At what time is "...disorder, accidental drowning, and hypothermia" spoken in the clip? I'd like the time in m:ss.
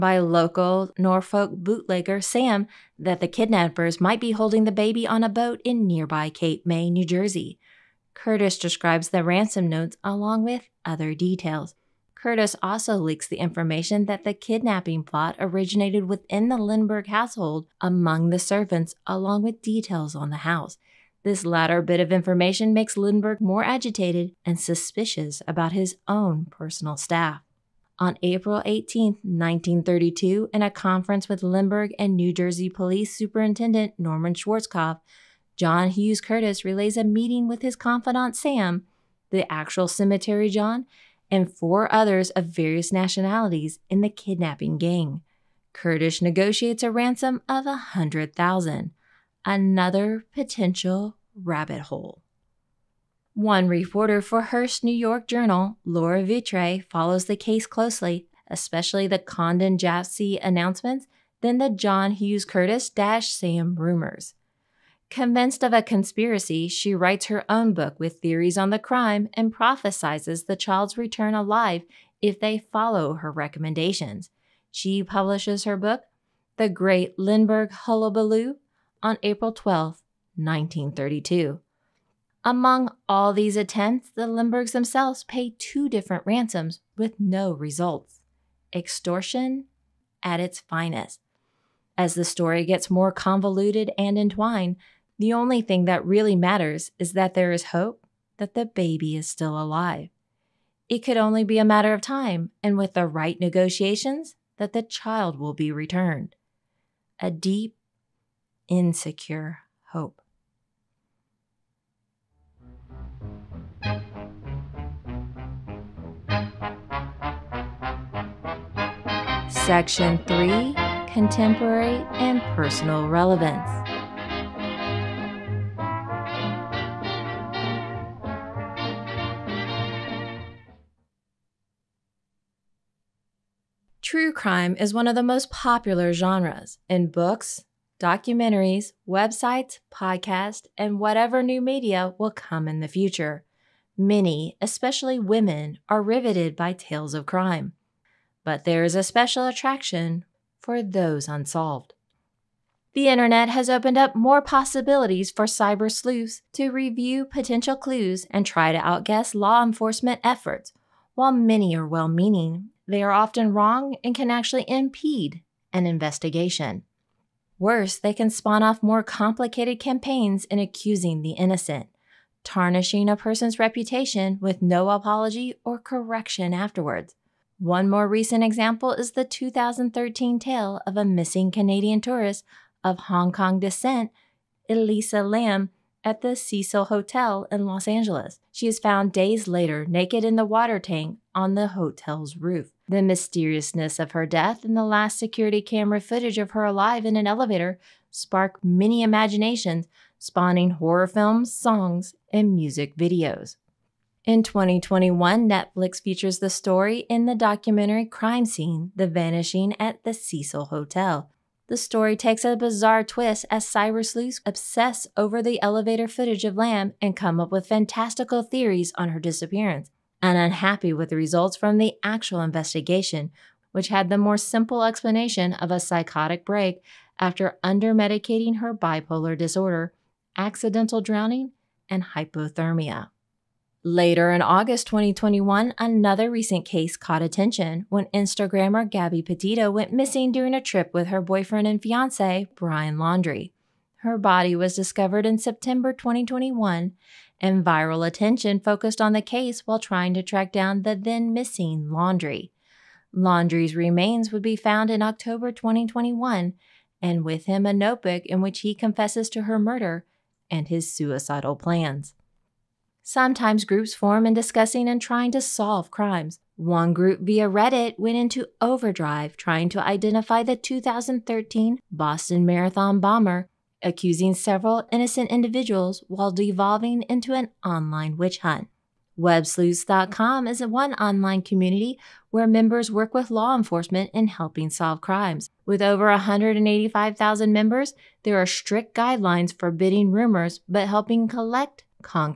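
3:49.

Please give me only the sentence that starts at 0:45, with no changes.
Curtis negotiates a ransom of a hundred thousand.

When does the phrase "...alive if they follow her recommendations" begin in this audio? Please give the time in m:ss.
1:11.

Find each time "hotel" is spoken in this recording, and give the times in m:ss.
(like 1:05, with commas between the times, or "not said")
3:06, 3:11, 3:30.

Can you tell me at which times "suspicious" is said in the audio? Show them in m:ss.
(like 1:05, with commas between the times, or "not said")
0:24.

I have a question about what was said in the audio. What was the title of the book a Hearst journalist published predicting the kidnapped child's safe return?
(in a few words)
The Great Lindbergh Hullabaloo.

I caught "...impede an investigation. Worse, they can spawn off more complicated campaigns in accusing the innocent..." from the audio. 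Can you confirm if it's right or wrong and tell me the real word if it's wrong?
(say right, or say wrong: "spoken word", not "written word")
right.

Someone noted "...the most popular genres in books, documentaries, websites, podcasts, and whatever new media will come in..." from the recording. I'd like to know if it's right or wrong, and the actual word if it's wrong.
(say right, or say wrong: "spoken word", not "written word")
right.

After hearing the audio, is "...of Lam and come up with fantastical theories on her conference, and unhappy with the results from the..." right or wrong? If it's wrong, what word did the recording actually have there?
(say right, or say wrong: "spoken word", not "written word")
wrong: "disappearance", not "conference".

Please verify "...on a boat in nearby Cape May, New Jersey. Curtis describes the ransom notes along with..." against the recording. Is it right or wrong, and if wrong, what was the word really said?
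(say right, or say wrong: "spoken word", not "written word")
right.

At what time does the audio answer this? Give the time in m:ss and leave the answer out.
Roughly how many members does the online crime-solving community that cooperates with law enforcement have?
4:46.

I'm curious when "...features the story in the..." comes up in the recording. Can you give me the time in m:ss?
3:26.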